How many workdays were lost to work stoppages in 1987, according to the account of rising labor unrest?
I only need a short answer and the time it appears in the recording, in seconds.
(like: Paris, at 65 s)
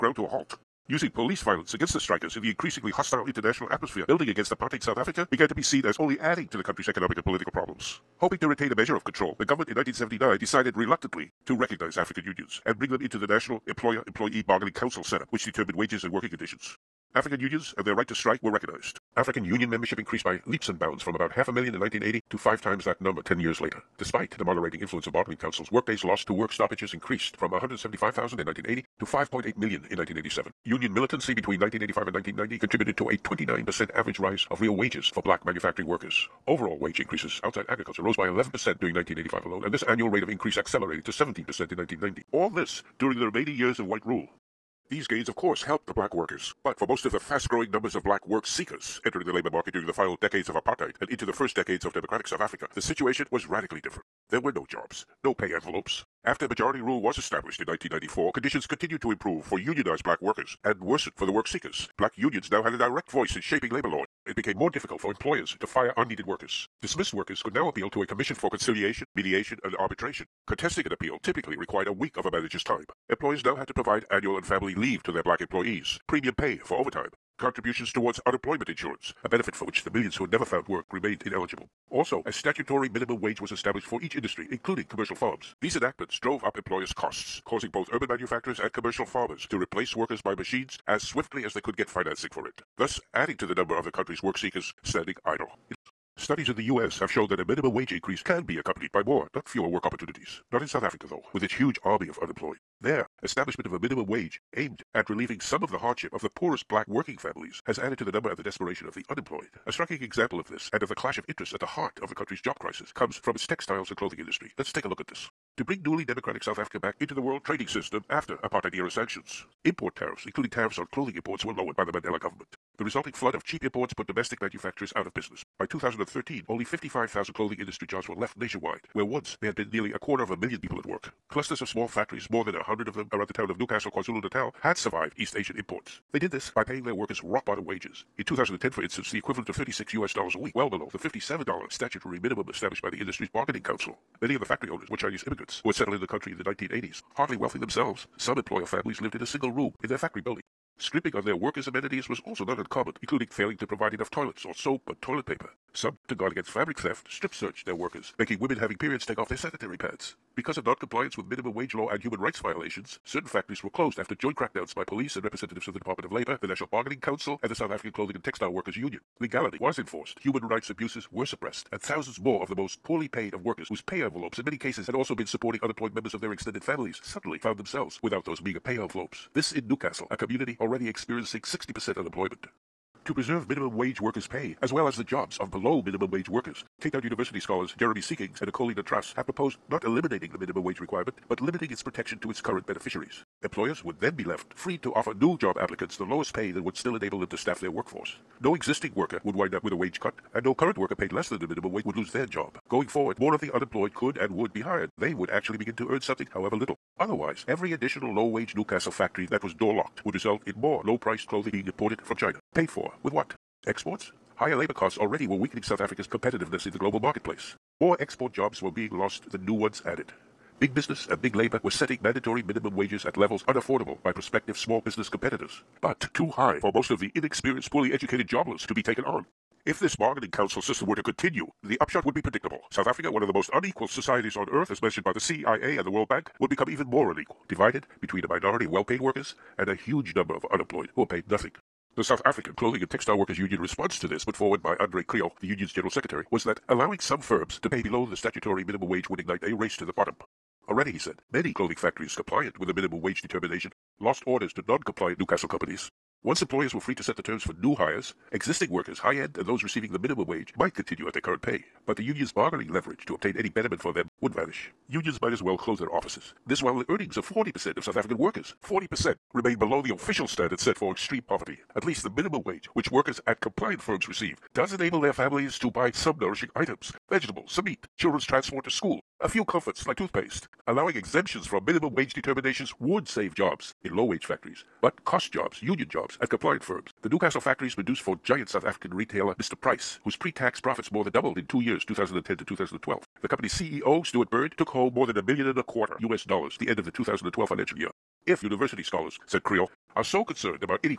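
5.8 million, at 29 s.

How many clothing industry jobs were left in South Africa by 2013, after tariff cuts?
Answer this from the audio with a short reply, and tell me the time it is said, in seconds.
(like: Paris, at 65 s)
55,000, at 126 s.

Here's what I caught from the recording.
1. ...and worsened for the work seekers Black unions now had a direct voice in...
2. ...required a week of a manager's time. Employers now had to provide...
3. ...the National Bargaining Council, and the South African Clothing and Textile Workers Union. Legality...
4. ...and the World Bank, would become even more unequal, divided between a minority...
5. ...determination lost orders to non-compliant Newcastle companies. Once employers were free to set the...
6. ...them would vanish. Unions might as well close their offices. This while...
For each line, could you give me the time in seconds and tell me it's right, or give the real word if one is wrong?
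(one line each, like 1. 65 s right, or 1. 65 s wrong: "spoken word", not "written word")
1. 60 s right
2. 71 s right
3. 166 s right
4. 235 s right
5. 253 s right
6. 263 s right.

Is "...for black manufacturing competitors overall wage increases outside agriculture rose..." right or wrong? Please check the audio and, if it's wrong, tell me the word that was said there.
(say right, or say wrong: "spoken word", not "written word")
wrong: "workers", not "competitors".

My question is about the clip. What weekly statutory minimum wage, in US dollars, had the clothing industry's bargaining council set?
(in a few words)
$57.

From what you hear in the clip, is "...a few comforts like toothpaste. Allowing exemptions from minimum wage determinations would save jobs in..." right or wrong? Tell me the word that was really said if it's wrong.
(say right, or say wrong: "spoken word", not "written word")
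right.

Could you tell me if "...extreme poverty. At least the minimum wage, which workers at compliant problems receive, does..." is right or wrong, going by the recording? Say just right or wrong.
wrong.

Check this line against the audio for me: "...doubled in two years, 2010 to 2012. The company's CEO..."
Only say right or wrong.
right.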